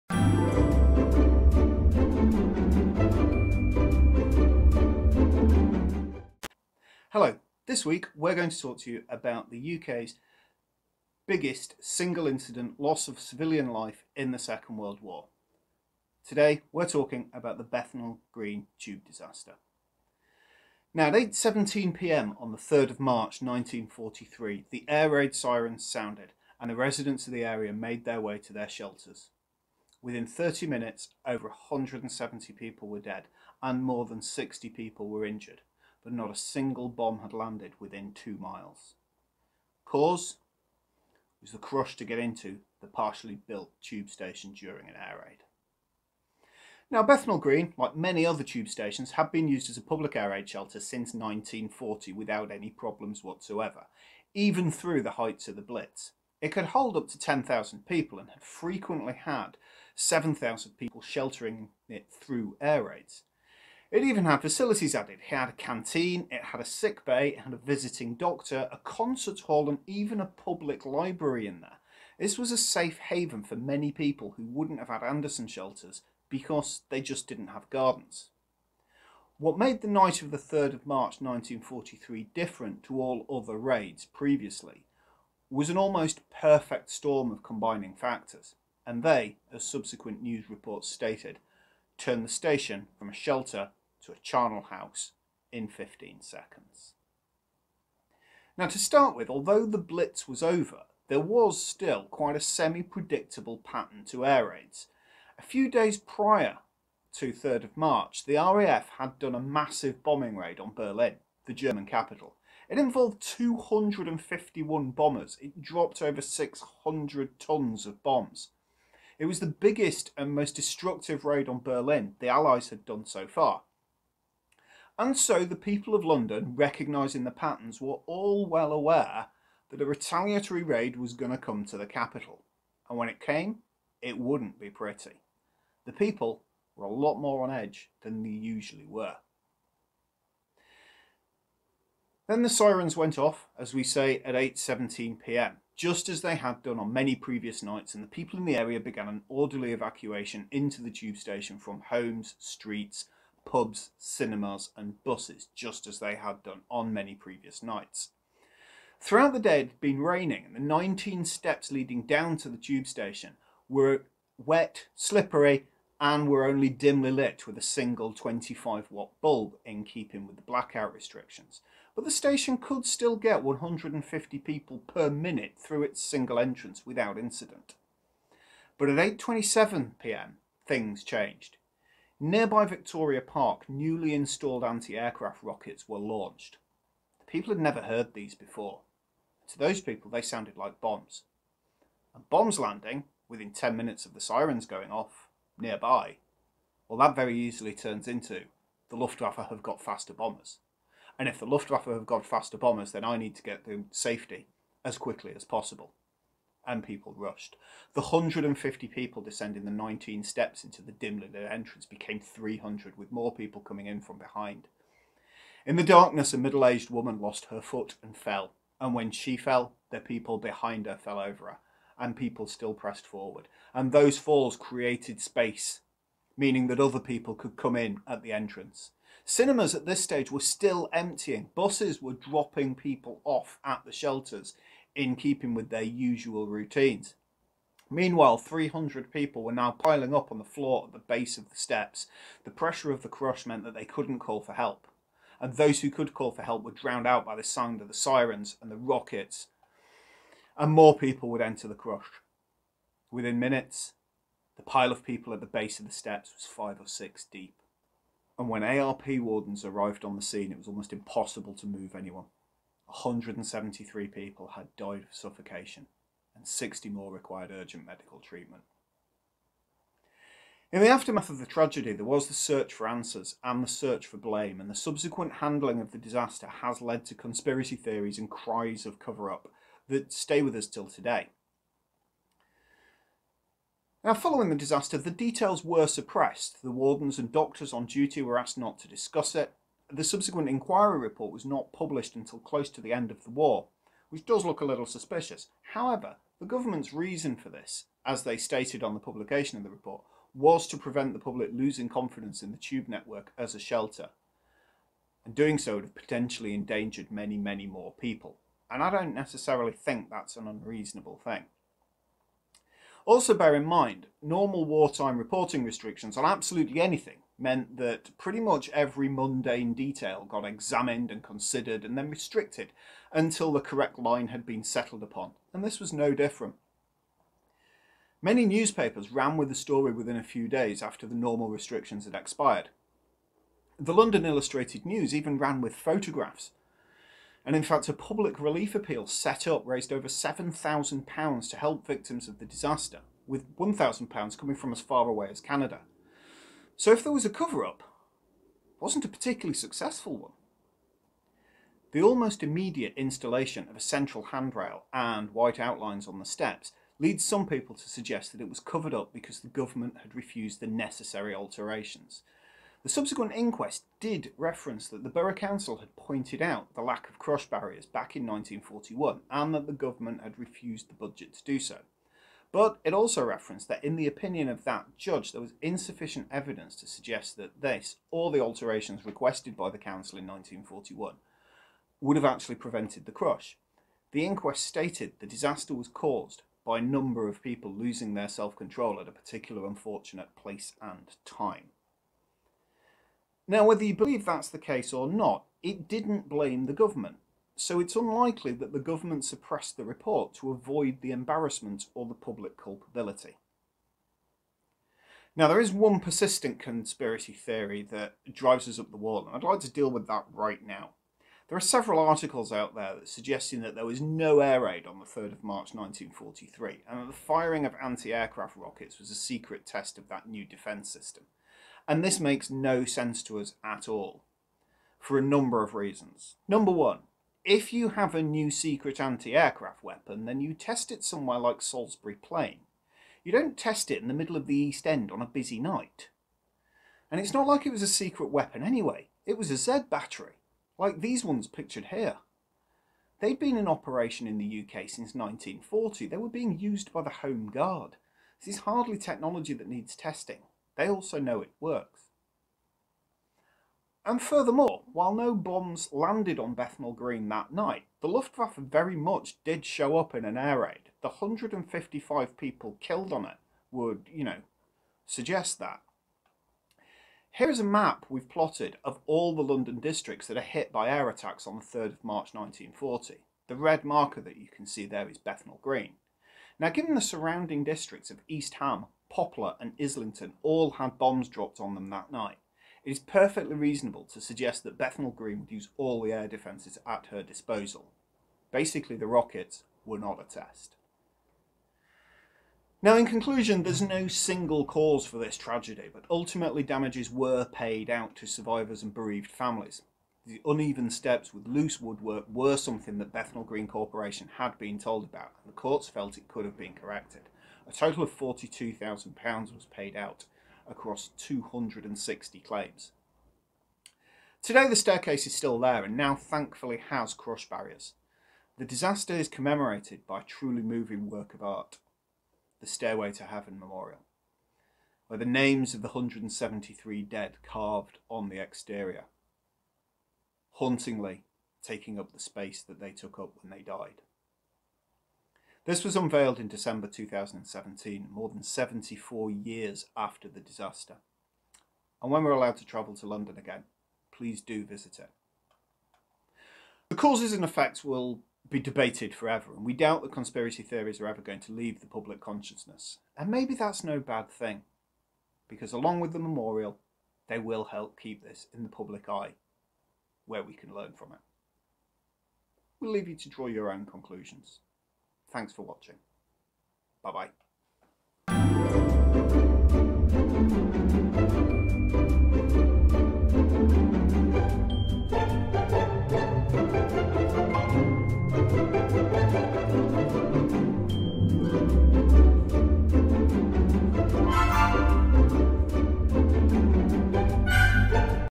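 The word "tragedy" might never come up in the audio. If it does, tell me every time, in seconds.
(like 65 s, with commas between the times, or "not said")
271 s, 495 s.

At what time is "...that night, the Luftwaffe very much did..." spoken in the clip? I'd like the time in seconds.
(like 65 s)
457 s.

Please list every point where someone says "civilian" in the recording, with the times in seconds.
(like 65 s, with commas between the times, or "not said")
13 s.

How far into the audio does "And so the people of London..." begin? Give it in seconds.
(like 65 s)
125 s.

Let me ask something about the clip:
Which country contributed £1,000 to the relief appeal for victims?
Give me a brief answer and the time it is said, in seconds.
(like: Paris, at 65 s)
Canada, at 345 s.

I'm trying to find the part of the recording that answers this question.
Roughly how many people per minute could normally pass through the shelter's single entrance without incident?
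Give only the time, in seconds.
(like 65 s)
173 s.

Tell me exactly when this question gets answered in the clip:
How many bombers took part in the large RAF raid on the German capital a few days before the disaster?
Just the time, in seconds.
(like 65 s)
113 s.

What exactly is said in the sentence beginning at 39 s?
Cause was the crush to get into the partially built tube station during an air raid.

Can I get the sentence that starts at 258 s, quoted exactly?
And when ARP wardens arrived on the scene, it was almost impossible to move anyone.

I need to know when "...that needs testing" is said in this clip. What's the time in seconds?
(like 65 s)
449 s.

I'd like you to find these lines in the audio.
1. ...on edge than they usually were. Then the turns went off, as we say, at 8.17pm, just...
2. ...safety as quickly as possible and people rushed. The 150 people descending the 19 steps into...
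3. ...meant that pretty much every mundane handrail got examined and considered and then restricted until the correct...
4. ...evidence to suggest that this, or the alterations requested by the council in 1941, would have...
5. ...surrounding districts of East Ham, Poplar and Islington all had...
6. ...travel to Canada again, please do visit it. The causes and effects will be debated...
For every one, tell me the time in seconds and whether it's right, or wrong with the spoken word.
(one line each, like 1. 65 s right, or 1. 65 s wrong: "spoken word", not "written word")
1. 137 s wrong: "sirens", not "turns"
2. 203 s right
3. 317 s wrong: "detail", not "handrail"
4. 376 s right
5. 477 s right
6. 542 s wrong: "London", not "Canada".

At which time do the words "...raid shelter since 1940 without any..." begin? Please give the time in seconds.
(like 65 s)
50 s.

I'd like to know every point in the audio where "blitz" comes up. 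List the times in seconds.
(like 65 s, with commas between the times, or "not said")
55 s, 99 s.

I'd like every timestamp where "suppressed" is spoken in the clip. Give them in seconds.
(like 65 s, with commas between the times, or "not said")
285 s, 399 s.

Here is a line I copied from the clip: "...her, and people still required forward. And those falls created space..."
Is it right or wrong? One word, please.
wrong.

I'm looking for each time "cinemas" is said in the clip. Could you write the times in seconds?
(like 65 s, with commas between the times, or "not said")
153 s, 229 s.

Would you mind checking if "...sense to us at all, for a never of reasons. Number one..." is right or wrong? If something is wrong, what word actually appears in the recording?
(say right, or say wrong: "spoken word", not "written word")
wrong: "number", not "never".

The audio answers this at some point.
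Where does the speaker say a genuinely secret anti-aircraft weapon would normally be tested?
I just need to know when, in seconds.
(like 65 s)
431 s.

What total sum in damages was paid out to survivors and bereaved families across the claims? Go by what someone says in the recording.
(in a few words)
£42,000.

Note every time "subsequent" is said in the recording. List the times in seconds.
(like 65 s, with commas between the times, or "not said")
89 s, 274 s, 290 s, 362 s.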